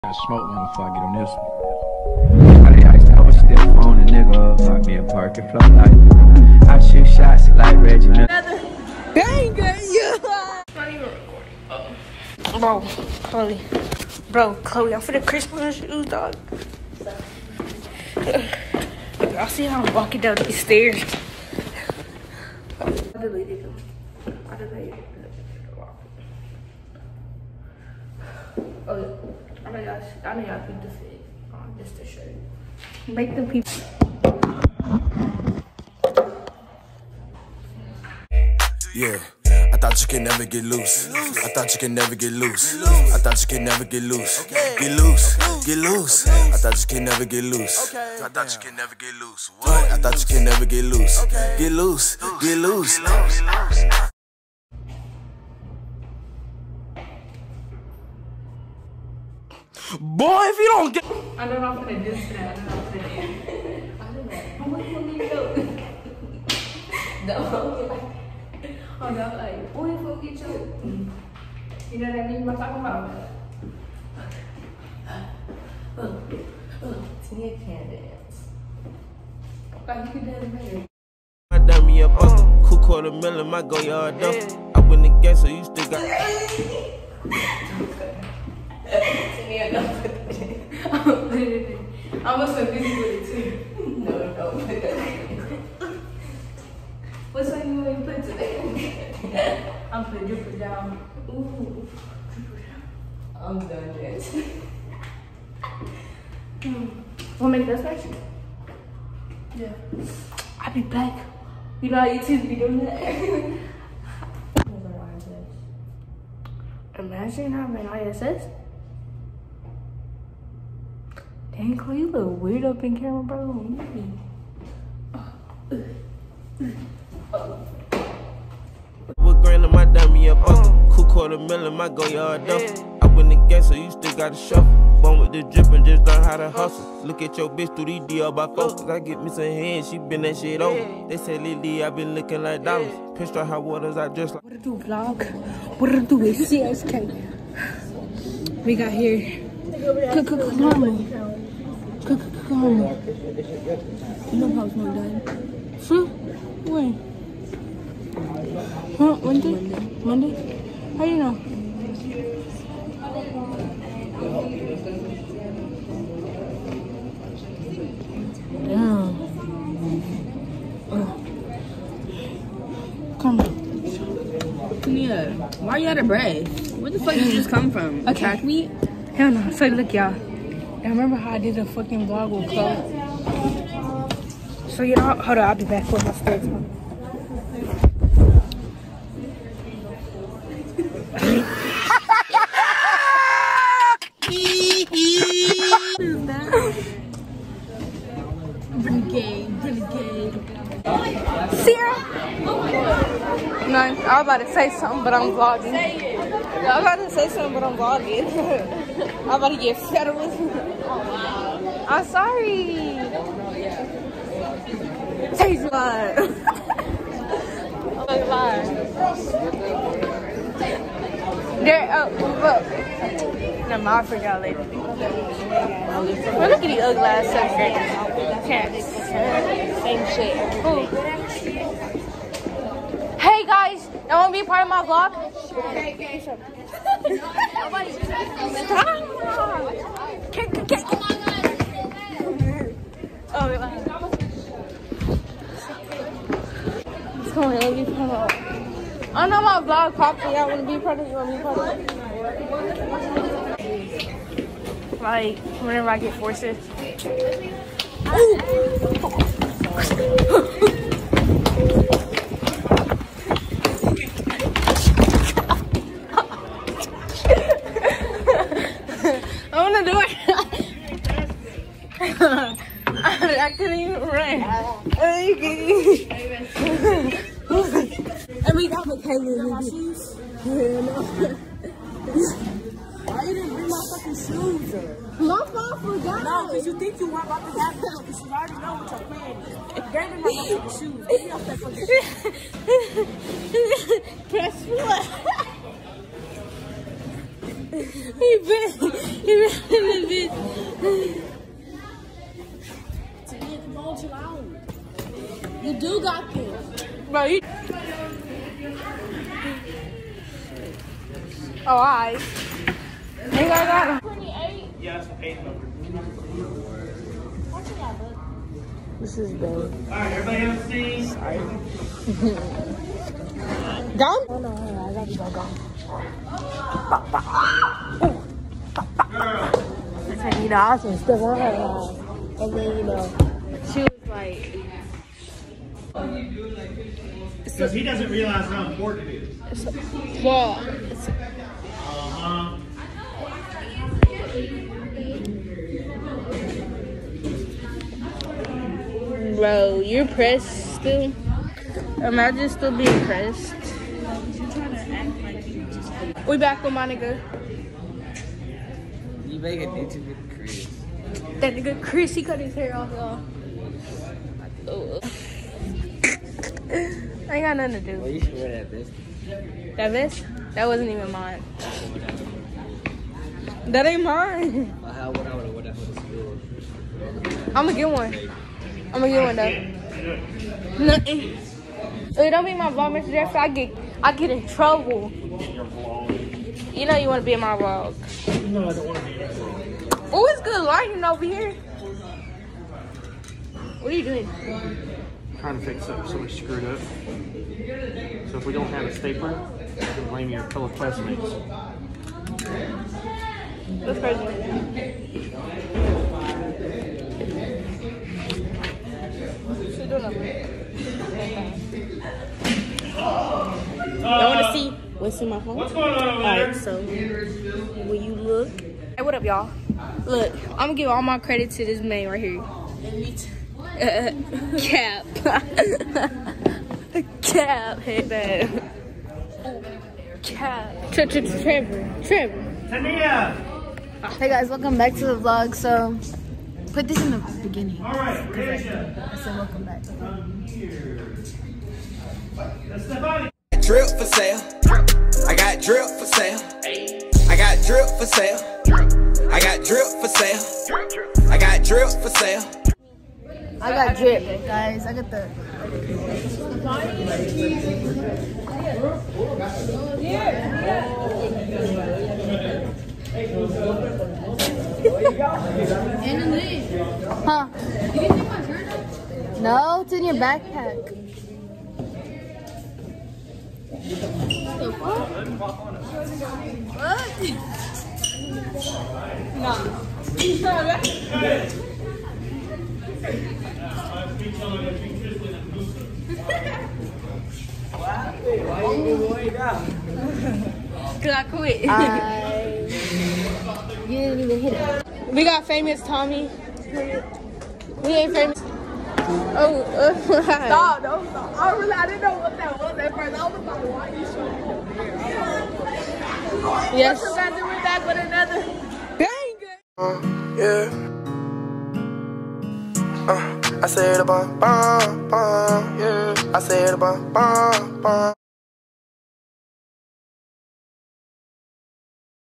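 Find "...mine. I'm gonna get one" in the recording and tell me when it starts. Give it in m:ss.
6:14.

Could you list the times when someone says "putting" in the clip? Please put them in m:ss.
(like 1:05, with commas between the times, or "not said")
1:40.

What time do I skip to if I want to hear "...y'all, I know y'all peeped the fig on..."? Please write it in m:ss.
0:29.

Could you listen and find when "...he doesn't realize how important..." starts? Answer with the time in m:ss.
5:37.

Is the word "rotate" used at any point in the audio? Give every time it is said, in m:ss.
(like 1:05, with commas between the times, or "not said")
not said.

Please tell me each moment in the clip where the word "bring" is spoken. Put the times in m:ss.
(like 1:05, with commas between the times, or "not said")
4:43.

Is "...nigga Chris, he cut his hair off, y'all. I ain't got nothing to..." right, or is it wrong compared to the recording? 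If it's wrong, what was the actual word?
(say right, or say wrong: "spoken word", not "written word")
right.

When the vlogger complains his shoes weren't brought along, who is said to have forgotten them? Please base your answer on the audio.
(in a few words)
My mom.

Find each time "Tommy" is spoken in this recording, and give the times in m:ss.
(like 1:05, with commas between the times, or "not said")
8:15.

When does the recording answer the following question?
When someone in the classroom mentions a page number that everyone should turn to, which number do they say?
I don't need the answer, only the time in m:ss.
5:14.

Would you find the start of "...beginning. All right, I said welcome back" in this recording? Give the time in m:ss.
7:17.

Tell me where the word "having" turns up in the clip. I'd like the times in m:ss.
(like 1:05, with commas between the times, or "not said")
1:57.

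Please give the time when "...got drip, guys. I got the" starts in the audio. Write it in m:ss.
7:33.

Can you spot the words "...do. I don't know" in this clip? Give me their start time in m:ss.
1:05.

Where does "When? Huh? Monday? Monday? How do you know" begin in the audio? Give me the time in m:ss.
2:36.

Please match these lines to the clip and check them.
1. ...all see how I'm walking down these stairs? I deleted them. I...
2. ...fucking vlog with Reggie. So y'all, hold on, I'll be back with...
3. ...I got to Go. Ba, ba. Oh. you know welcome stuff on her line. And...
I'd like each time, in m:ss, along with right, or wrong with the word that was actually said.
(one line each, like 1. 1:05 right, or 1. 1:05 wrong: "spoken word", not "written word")
1. 0:19 right
2. 3:01 wrong: "Chloe", not "Reggie"
3. 5:24 wrong: "awesome", not "welcome".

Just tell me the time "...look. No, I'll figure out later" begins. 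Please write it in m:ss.
3:42.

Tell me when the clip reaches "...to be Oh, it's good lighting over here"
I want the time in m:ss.
6:28.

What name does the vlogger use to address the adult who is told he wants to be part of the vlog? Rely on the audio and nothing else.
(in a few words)
Mr. Jeff.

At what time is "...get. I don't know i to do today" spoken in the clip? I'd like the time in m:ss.
1:00.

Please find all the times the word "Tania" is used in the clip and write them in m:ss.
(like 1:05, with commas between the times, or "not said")
7:12.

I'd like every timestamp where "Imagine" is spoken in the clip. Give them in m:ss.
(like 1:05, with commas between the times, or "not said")
1:56, 5:52.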